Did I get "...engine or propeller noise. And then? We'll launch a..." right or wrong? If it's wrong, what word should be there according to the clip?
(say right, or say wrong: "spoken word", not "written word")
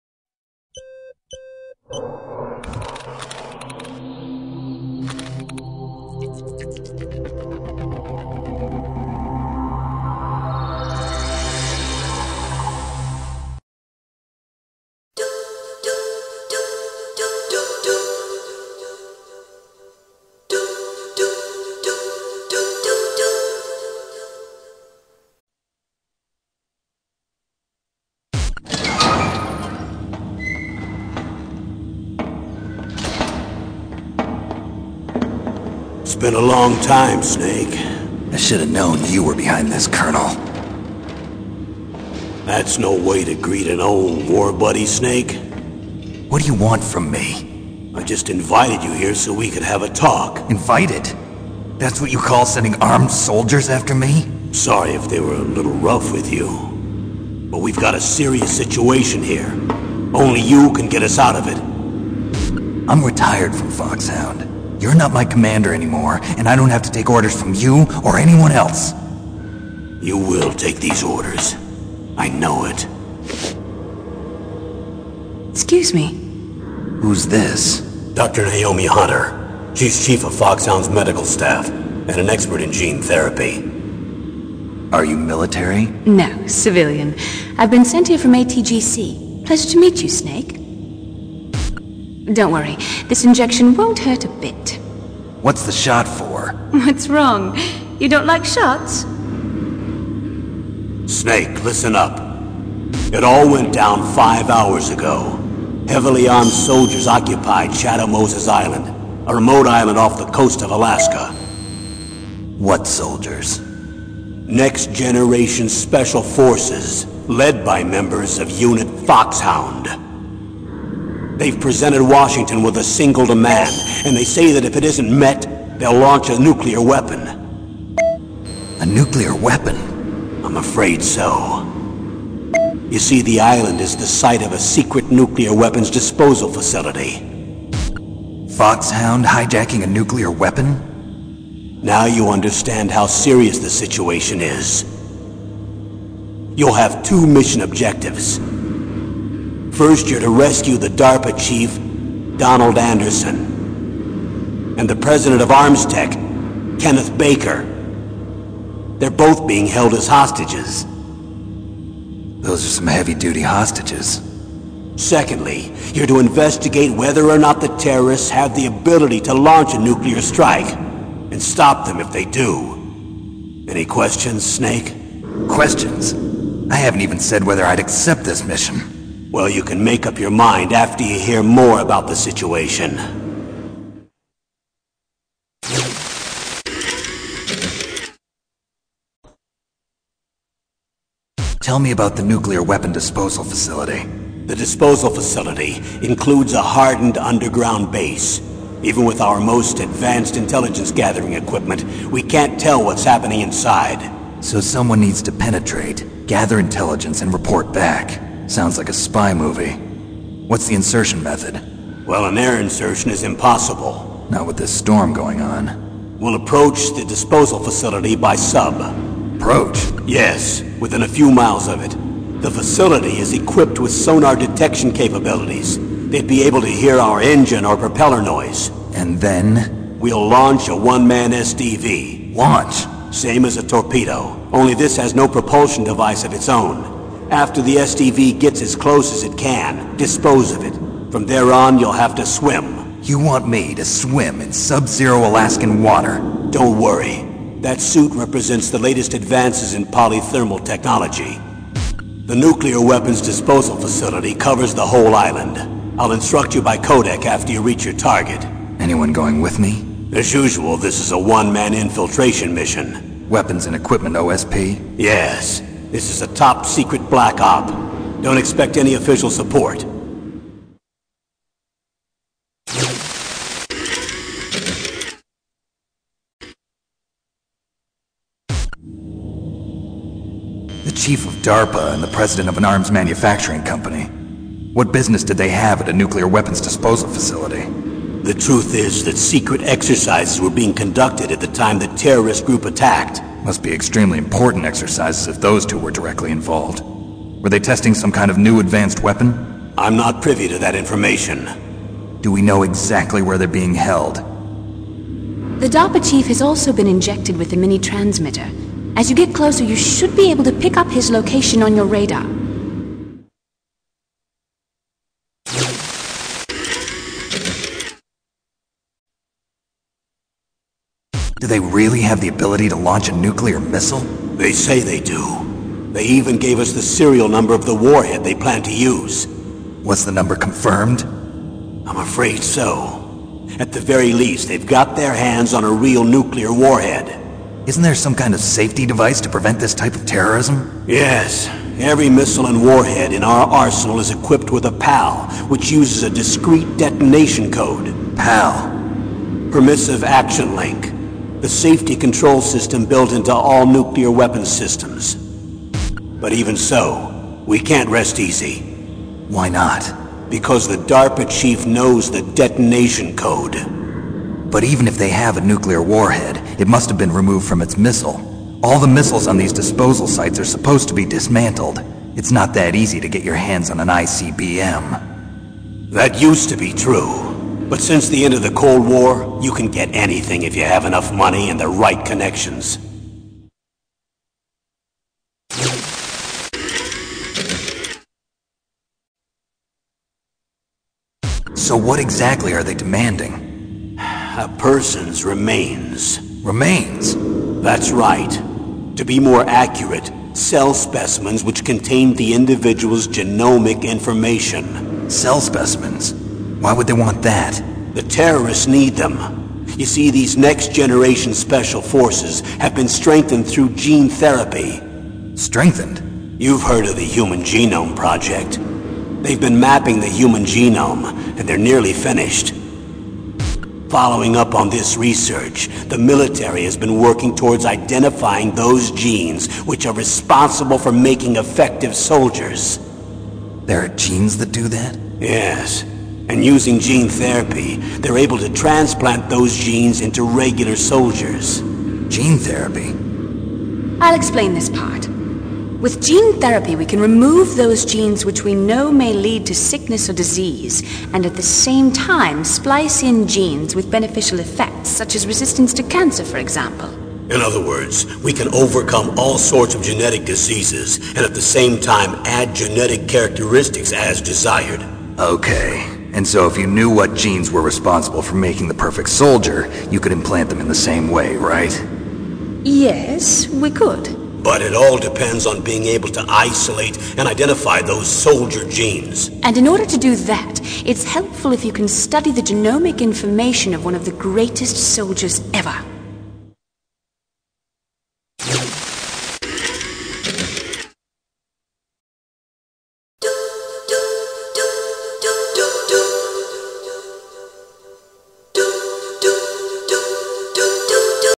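right.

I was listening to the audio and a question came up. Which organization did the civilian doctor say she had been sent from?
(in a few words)
ATGC.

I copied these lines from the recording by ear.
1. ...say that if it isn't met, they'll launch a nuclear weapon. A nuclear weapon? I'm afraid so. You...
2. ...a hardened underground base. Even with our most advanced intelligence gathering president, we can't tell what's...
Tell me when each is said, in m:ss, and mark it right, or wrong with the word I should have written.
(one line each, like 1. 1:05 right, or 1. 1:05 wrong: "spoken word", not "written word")
1. 2:04 right
2. 3:16 wrong: "equipment", not "president".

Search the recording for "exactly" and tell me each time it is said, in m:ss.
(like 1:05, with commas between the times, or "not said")
5:02, 6:32.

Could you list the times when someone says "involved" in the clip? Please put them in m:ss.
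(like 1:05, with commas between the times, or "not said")
4:56.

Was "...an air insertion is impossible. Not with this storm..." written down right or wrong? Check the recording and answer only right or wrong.
right.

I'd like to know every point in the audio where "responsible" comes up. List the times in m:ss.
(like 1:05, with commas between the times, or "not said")
7:09, 7:47.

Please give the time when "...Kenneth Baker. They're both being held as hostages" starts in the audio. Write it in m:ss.
2:36.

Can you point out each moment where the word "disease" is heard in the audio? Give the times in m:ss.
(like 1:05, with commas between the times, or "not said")
7:30, 7:40.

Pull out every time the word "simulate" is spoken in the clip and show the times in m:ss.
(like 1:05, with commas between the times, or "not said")
not said.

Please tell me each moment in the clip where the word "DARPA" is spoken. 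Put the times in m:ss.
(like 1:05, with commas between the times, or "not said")
2:30, 4:41, 5:05, 6:00.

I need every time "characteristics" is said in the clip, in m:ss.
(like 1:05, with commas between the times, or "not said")
7:43.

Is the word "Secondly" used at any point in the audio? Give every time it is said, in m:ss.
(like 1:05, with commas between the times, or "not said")
2:44.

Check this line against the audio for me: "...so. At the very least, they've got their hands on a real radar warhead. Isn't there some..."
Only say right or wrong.
wrong.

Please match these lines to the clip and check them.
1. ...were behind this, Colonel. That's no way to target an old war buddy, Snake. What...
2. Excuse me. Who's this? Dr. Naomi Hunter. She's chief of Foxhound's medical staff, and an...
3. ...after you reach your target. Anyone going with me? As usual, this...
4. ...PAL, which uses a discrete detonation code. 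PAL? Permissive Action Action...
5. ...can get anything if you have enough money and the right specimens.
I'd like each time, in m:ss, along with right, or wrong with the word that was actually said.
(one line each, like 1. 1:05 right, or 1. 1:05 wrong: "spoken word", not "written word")
1. 0:39 wrong: "greet", not "target"
2. 1:15 right
3. 4:17 right
4. 5:44 wrong: "Link", not "Action"
5. 6:19 wrong: "connections", not "specimens".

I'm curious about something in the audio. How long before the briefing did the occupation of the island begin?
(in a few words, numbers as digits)
Five hours.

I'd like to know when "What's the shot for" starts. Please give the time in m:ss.
1:35.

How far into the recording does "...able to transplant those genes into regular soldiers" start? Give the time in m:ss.
7:18.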